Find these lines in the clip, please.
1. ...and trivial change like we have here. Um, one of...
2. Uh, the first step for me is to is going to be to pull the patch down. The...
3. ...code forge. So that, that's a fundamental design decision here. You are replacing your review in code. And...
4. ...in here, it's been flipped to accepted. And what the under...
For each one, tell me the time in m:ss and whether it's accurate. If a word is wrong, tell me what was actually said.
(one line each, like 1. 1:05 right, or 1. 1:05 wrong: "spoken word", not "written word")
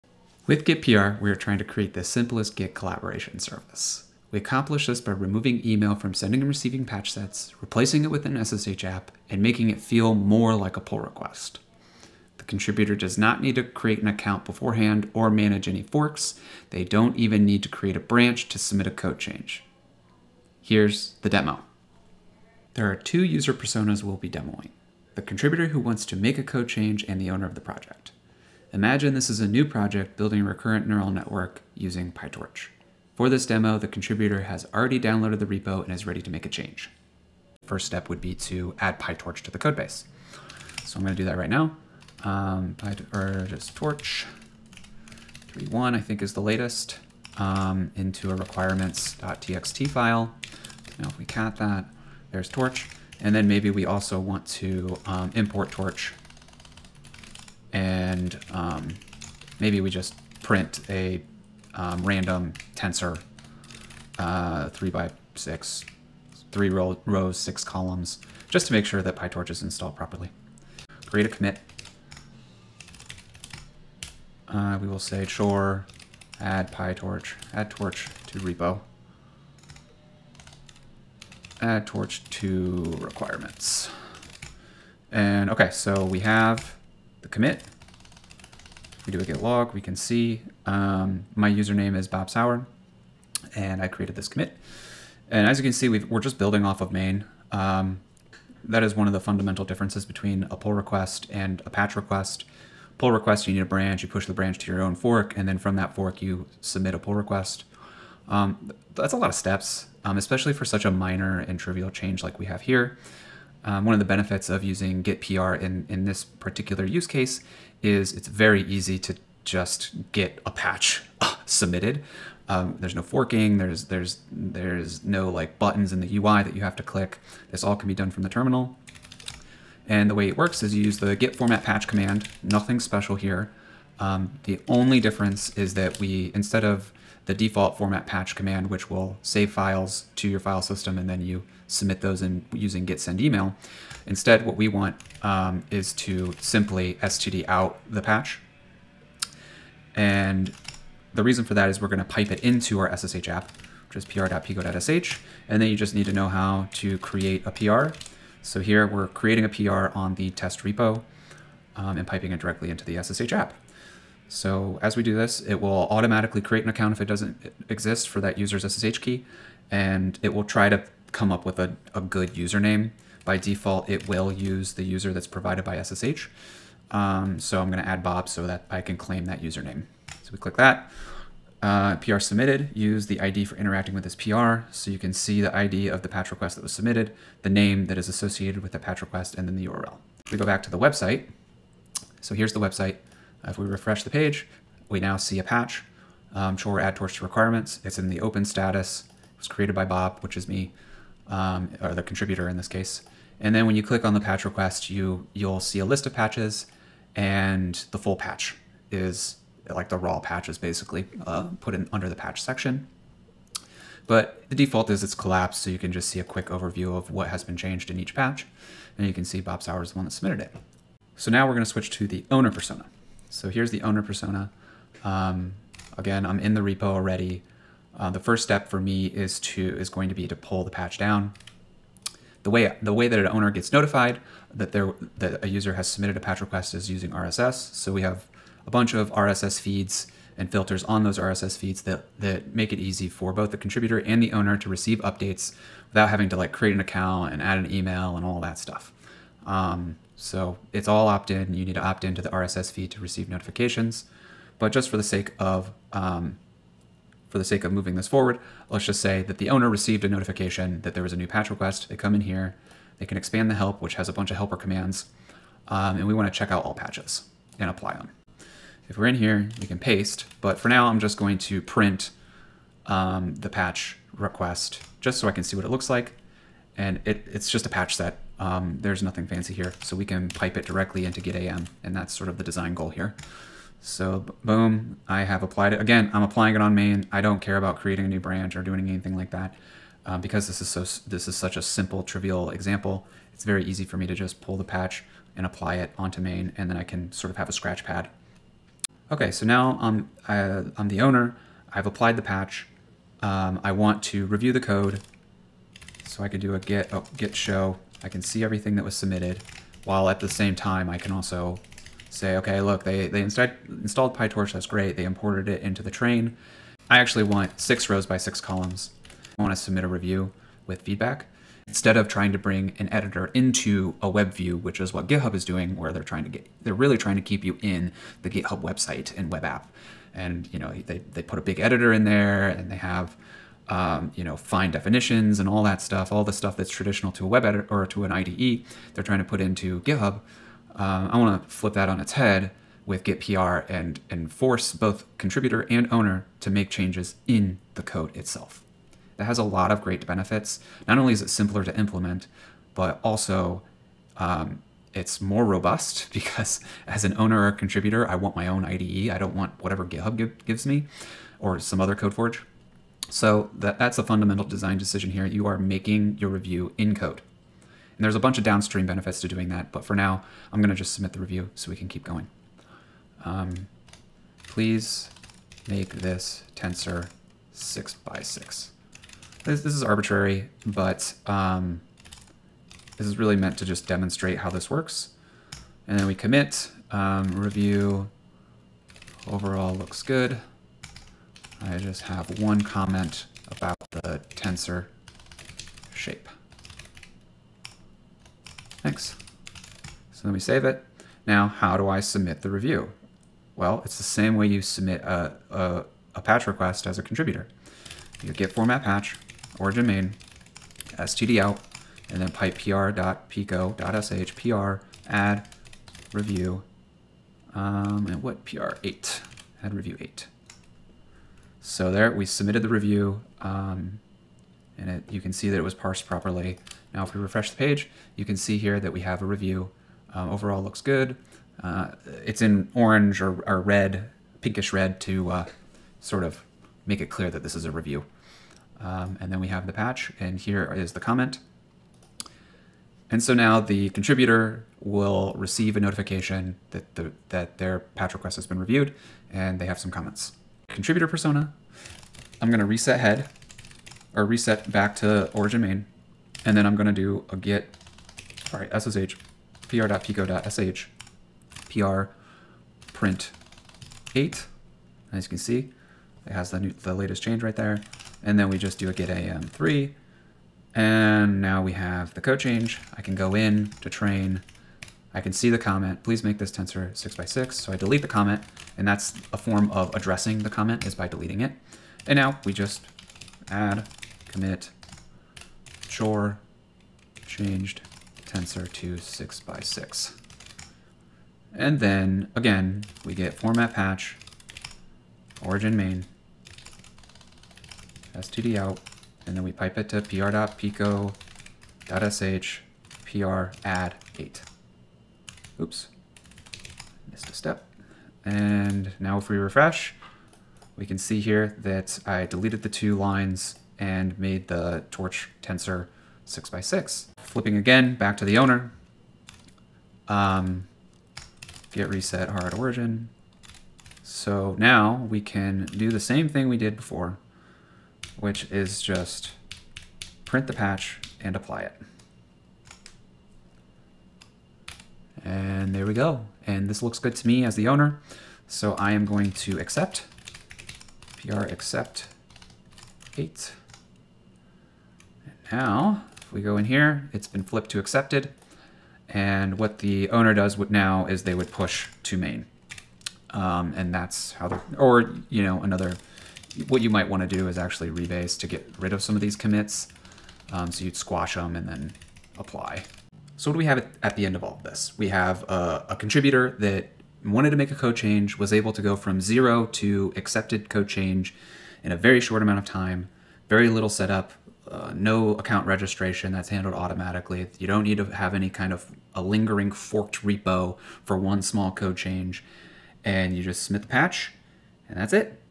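1. 1:51 right
2. 3:47 right
3. 6:01 wrong: "making", not "replacing"
4. 9:06 wrong: "owner", not "under".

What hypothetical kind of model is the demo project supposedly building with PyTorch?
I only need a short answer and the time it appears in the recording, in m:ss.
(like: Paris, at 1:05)
recurrent neural network, at 0:30.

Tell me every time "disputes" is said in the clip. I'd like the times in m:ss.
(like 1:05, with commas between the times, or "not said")
not said.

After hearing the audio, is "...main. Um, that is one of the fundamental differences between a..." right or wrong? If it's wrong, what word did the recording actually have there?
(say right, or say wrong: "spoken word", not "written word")
right.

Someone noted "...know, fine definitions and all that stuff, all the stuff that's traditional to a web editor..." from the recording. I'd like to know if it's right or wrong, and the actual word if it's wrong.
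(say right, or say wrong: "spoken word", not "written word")
right.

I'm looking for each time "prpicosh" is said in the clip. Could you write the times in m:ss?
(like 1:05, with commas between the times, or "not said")
2:34, 6:52, 7:39, 8:20.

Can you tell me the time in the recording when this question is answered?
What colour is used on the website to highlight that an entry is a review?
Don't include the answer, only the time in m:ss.
7:14.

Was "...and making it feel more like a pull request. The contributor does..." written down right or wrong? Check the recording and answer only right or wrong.
right.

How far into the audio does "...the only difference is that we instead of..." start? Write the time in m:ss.
2:14.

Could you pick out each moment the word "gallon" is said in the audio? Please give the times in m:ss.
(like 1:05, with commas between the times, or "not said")
not said.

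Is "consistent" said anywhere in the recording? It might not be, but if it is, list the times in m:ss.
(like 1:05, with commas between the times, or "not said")
not said.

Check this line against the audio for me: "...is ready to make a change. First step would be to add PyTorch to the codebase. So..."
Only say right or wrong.
right.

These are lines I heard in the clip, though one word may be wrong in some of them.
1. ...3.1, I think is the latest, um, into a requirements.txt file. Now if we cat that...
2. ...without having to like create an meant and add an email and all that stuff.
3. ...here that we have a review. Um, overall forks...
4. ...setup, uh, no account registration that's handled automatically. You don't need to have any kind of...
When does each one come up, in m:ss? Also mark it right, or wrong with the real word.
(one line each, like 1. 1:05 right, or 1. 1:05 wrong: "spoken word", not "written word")
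1. 0:45 right
2. 4:05 wrong: "account", not "meant"
3. 7:08 wrong: "looks", not "forks"
4. 9:33 right.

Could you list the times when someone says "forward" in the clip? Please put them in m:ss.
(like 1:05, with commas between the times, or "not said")
4:18.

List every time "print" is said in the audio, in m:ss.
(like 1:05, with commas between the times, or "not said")
1:00, 4:31, 7:42, 8:50.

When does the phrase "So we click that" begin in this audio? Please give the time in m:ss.
3:00.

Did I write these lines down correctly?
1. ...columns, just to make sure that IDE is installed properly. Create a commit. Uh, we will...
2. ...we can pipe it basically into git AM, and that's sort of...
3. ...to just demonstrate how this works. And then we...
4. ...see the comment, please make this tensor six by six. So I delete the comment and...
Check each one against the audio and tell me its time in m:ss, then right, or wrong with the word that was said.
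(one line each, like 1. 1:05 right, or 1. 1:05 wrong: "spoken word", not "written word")
1. 1:07 wrong: "PyTorch", not "IDE"
2. 4:39 wrong: "directly", not "basically"
3. 6:23 right
4. 7:55 right.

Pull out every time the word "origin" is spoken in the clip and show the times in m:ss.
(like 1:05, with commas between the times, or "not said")
6:49, 7:35, 8:15, 8:42.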